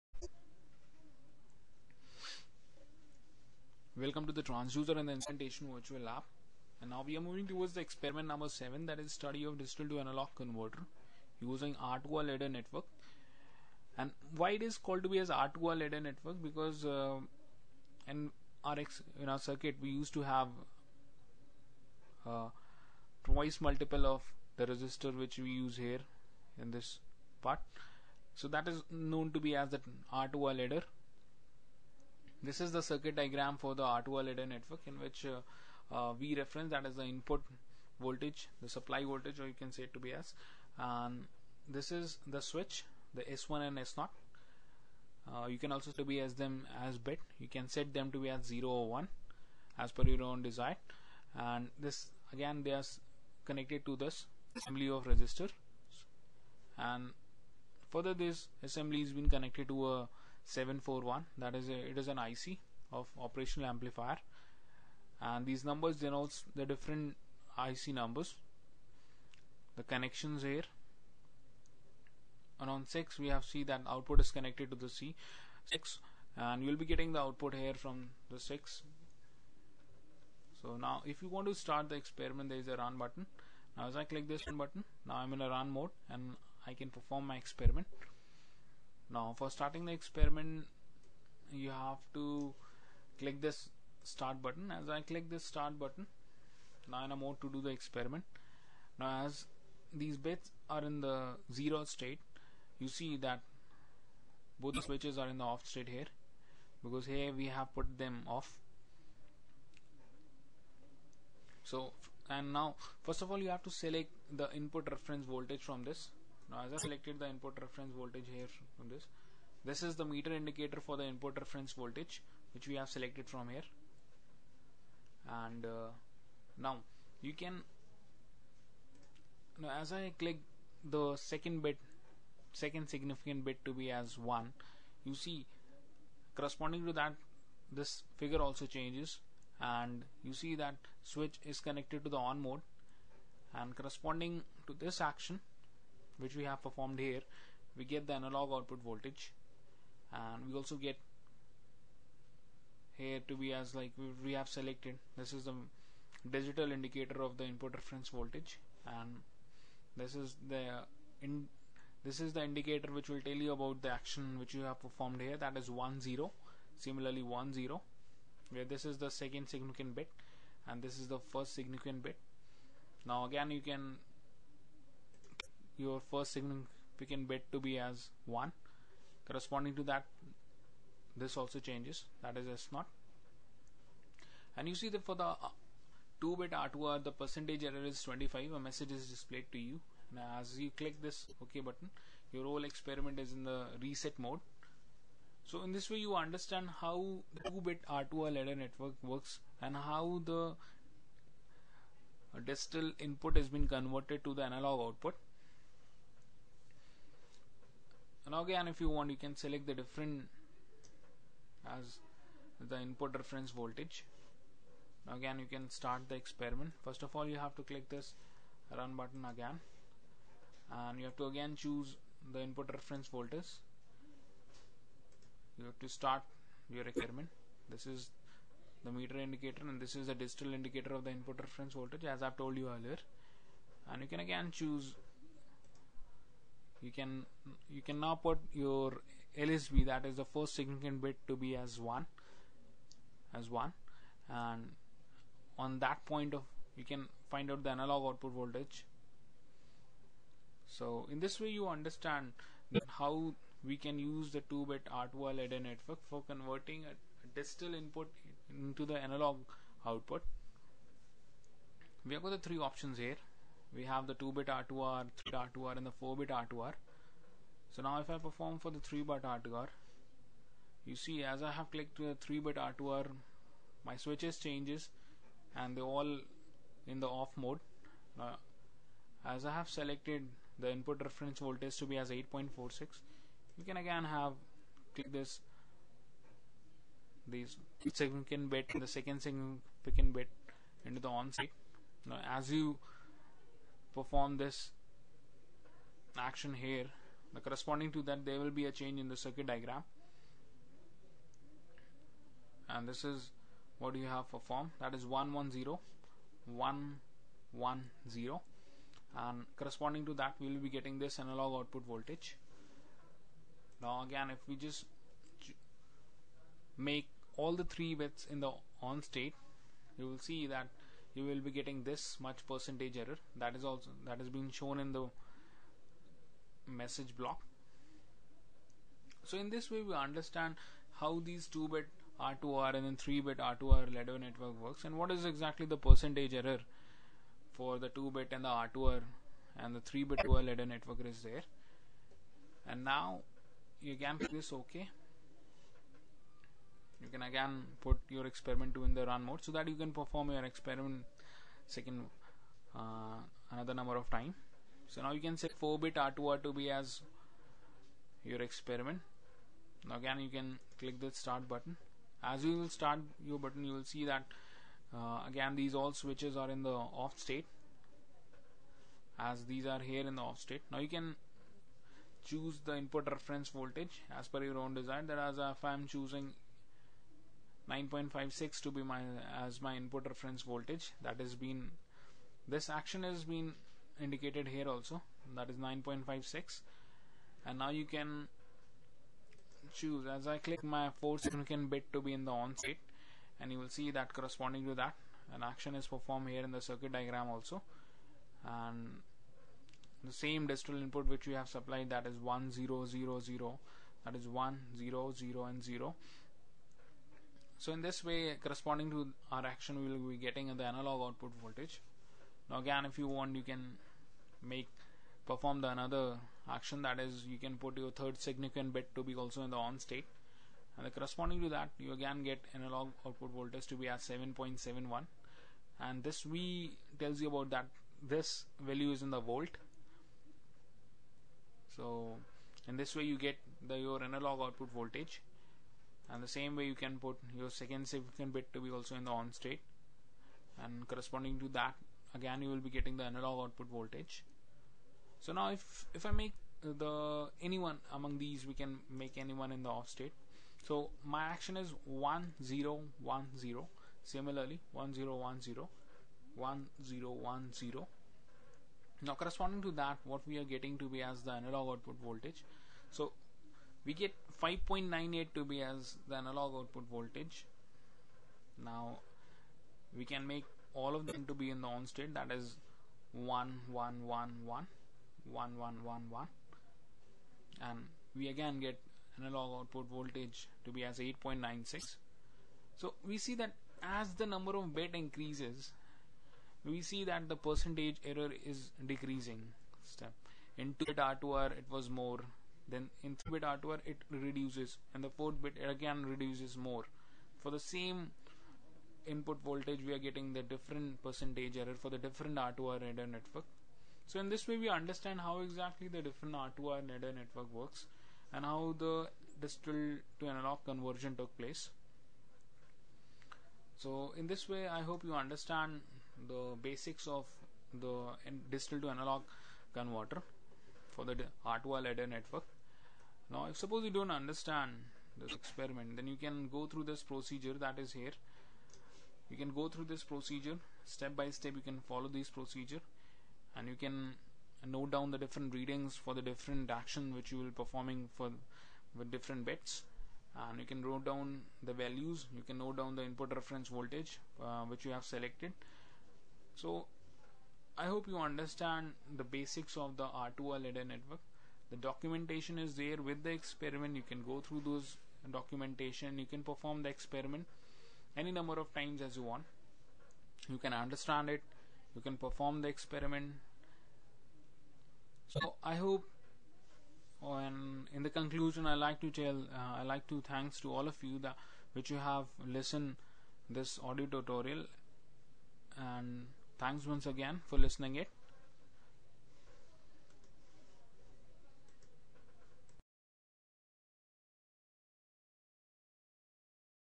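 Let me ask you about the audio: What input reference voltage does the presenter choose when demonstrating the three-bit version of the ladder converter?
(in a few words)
8.46.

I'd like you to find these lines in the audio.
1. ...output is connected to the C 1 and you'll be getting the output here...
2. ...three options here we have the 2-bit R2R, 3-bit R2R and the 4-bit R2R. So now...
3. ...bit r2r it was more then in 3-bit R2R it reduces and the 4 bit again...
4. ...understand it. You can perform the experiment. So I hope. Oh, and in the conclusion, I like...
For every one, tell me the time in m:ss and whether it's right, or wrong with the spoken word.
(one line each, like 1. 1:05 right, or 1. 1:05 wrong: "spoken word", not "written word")
1. 1:13 wrong: "6", not "1"
2. 4:22 right
3. 8:10 right
4. 9:20 right.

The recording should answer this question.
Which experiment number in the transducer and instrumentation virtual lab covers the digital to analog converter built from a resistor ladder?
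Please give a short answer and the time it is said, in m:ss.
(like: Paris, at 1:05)
7, at 0:07.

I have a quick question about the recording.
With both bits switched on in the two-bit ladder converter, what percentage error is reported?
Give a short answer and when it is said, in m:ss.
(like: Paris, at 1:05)
25, at 3:08.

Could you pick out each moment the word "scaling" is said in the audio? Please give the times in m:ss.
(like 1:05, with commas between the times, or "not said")
not said.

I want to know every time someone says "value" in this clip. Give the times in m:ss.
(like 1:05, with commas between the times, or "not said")
7:08, 9:01.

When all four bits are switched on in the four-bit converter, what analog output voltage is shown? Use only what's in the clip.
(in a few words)
8.96.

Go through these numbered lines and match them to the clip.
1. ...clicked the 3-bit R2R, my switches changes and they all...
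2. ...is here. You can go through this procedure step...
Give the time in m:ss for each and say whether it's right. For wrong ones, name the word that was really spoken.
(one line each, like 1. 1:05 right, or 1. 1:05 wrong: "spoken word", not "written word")
1. 4:31 right
2. 8:47 right.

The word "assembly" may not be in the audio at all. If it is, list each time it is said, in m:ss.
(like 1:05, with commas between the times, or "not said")
0:54, 0:58.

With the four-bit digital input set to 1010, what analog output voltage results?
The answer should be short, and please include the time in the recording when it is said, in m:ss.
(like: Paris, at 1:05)
5.98, at 7:44.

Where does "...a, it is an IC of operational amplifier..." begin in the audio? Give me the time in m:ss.
1:01.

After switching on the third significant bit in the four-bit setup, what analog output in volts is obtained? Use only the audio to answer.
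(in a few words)
7.71.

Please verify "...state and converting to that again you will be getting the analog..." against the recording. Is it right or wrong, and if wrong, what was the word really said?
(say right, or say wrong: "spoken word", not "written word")
wrong: "corresponding", not "converting".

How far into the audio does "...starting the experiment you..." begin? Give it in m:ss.
1:29.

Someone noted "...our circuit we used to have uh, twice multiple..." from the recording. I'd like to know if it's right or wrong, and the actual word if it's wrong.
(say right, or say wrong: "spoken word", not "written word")
right.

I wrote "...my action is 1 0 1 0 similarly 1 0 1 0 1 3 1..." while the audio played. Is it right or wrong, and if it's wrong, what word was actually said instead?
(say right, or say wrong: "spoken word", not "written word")
wrong: "0", not "3".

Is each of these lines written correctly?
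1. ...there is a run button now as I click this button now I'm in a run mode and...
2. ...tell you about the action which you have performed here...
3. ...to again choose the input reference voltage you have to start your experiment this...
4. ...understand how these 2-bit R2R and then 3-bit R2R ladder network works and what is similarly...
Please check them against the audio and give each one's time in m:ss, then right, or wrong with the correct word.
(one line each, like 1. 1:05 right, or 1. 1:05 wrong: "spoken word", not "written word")
1. 1:22 right
2. 2:43 right
3. 3:41 right
4. 5:29 wrong: "exactly", not "similarly".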